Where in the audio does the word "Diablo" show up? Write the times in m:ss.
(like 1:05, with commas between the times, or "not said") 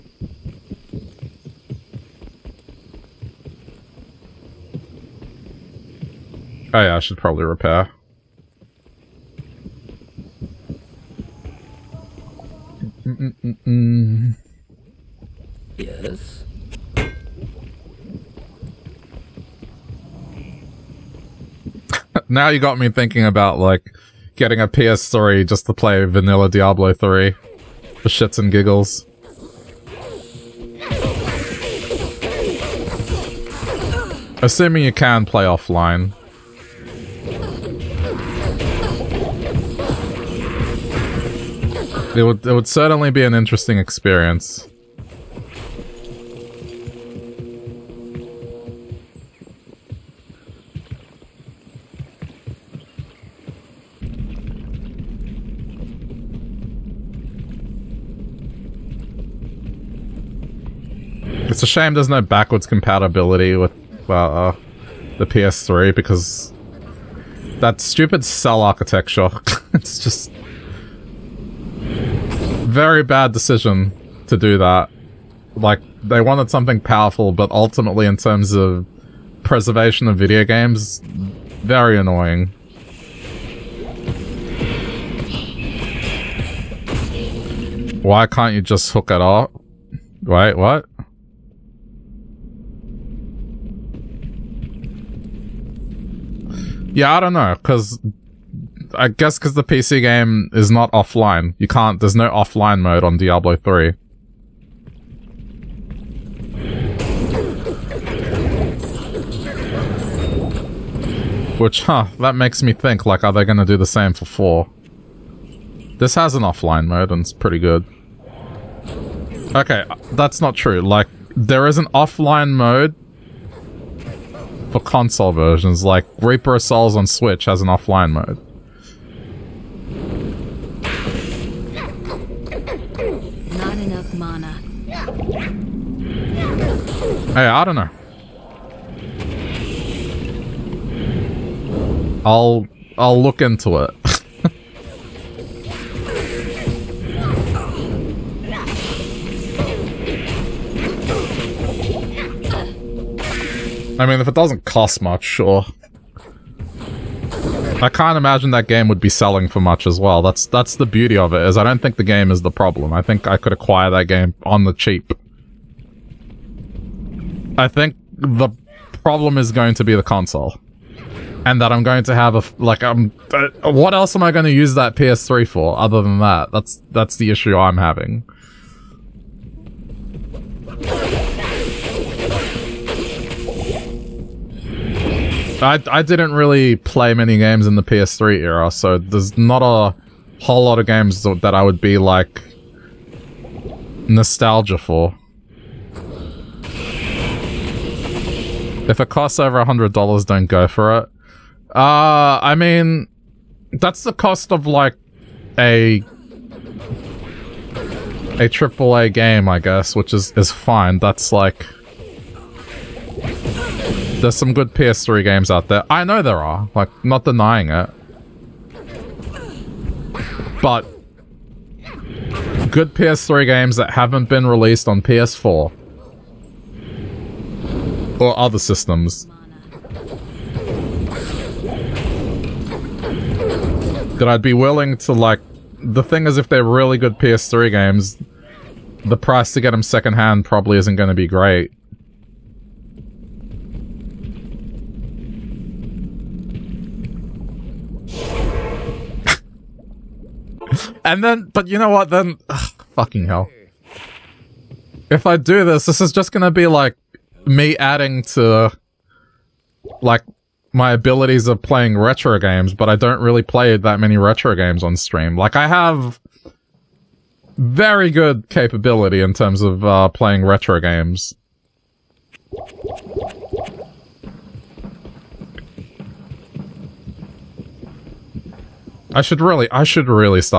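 0:26, 1:43.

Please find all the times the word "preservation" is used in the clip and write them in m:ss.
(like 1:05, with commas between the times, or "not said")
1:19.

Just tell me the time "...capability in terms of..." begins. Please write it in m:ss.
4:28.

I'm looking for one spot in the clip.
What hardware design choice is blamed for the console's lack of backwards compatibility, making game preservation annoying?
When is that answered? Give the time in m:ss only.
1:08.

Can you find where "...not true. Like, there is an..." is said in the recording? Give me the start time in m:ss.
2:00.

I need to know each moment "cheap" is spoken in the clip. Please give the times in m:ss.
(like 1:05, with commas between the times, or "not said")
2:44.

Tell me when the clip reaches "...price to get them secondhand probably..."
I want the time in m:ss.
3:59.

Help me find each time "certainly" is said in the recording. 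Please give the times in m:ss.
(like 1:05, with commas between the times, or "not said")
0:42.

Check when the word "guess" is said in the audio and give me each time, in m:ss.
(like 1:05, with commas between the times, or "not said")
1:39, 3:29.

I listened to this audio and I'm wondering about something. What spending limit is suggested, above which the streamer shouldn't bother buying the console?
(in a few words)
$100.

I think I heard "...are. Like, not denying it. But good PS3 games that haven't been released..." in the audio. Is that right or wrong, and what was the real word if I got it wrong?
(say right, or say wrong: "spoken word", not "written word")
right.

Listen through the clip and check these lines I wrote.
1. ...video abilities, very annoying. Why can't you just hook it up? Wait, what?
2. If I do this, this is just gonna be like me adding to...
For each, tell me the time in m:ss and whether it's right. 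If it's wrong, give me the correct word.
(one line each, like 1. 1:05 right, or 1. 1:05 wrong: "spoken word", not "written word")
1. 1:20 wrong: "games", not "abilities"
2. 4:15 right.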